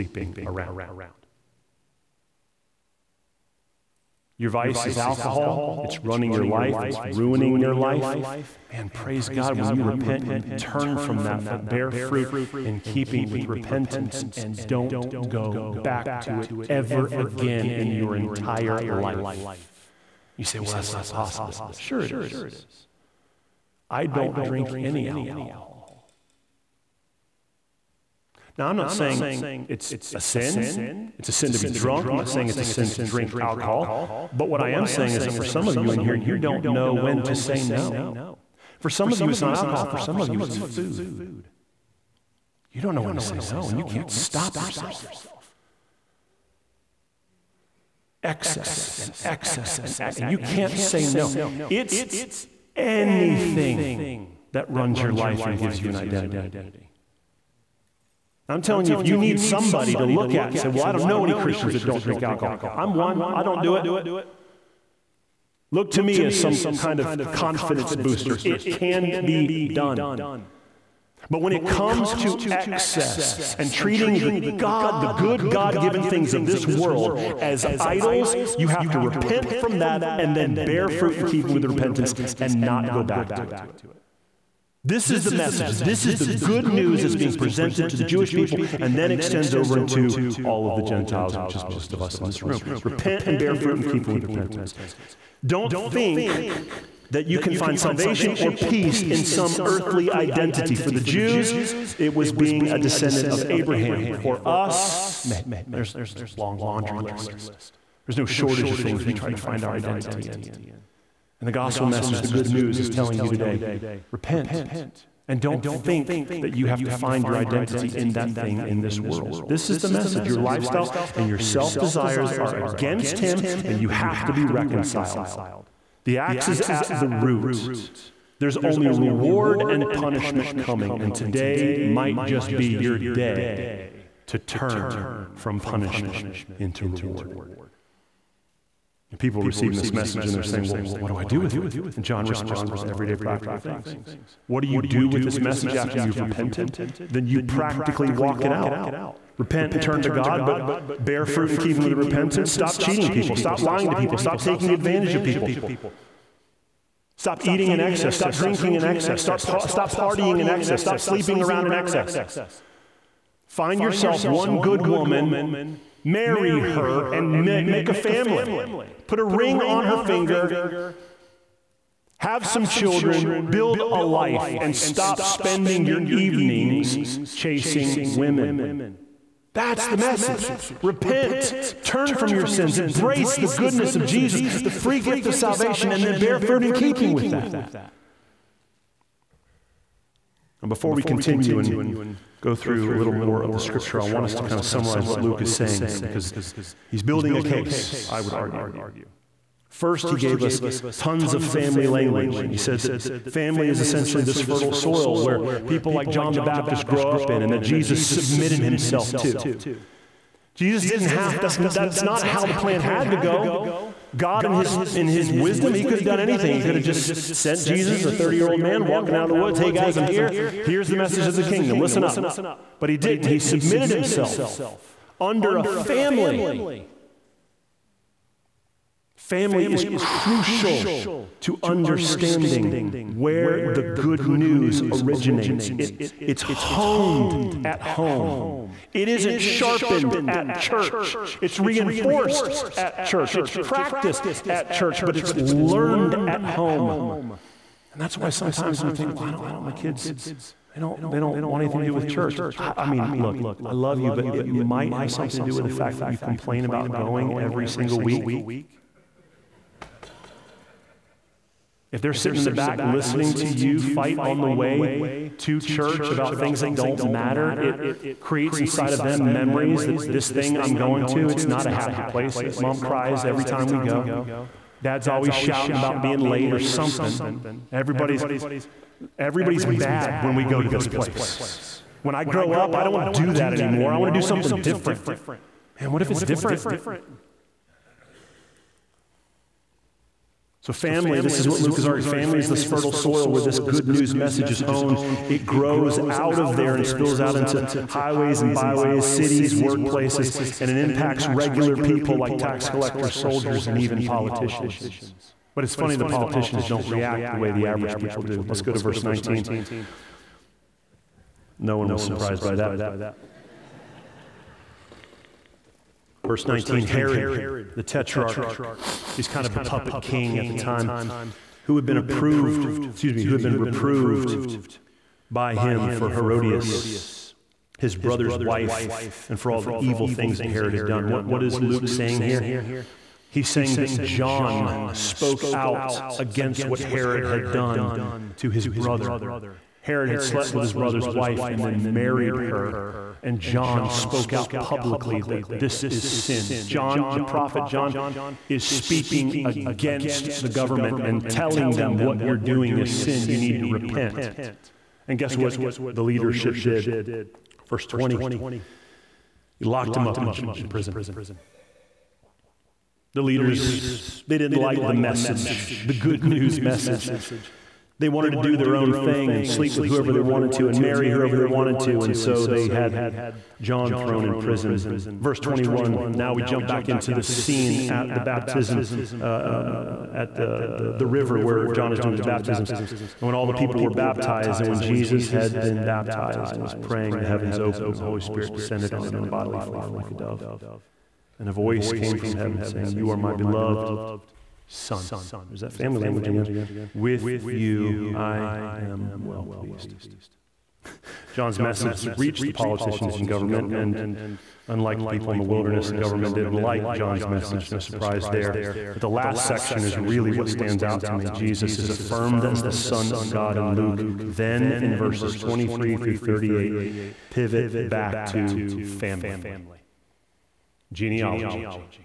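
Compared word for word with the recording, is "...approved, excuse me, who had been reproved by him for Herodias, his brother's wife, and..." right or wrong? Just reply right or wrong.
right.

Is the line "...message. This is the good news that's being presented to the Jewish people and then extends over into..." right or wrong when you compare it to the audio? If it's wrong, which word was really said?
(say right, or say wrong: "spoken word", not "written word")
right.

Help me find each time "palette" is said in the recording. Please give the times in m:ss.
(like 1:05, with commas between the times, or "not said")
not said.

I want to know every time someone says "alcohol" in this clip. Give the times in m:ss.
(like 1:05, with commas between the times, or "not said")
0:04, 0:25, 0:33, 0:39, 1:02.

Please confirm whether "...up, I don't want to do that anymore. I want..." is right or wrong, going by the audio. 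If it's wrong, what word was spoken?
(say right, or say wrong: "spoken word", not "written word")
right.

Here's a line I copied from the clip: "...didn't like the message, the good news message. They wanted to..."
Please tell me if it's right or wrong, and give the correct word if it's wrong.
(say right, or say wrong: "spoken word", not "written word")
right.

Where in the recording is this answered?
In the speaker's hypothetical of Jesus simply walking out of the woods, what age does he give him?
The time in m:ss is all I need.
3:38.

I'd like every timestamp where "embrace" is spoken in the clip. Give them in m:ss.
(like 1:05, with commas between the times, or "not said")
3:02.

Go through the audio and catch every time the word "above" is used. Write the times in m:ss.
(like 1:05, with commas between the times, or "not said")
not said.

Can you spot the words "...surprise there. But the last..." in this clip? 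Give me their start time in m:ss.
6:47.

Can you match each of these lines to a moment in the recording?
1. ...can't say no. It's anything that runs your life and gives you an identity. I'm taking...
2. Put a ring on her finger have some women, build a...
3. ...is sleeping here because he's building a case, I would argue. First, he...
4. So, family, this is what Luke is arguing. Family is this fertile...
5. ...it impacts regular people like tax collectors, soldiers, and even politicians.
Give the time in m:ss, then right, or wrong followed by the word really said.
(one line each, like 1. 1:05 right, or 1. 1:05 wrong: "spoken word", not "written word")
1. 0:50 wrong: "telling", not "taking"
2. 2:49 wrong: "children", not "women"
3. 3:15 wrong: "saying", not "sleeping"
4. 4:50 right
5. 5:00 right.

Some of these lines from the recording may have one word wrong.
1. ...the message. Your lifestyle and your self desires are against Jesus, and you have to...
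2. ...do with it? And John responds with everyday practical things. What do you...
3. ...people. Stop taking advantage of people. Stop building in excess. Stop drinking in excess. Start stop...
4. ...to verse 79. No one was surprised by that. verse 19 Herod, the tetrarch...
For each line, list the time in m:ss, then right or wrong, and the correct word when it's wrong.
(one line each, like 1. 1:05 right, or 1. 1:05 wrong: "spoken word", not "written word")
1. 1:59 wrong: "Him", not "Jesus"
2. 2:21 right
3. 2:33 wrong: "eating", not "building"
4. 5:08 wrong: "19", not "79".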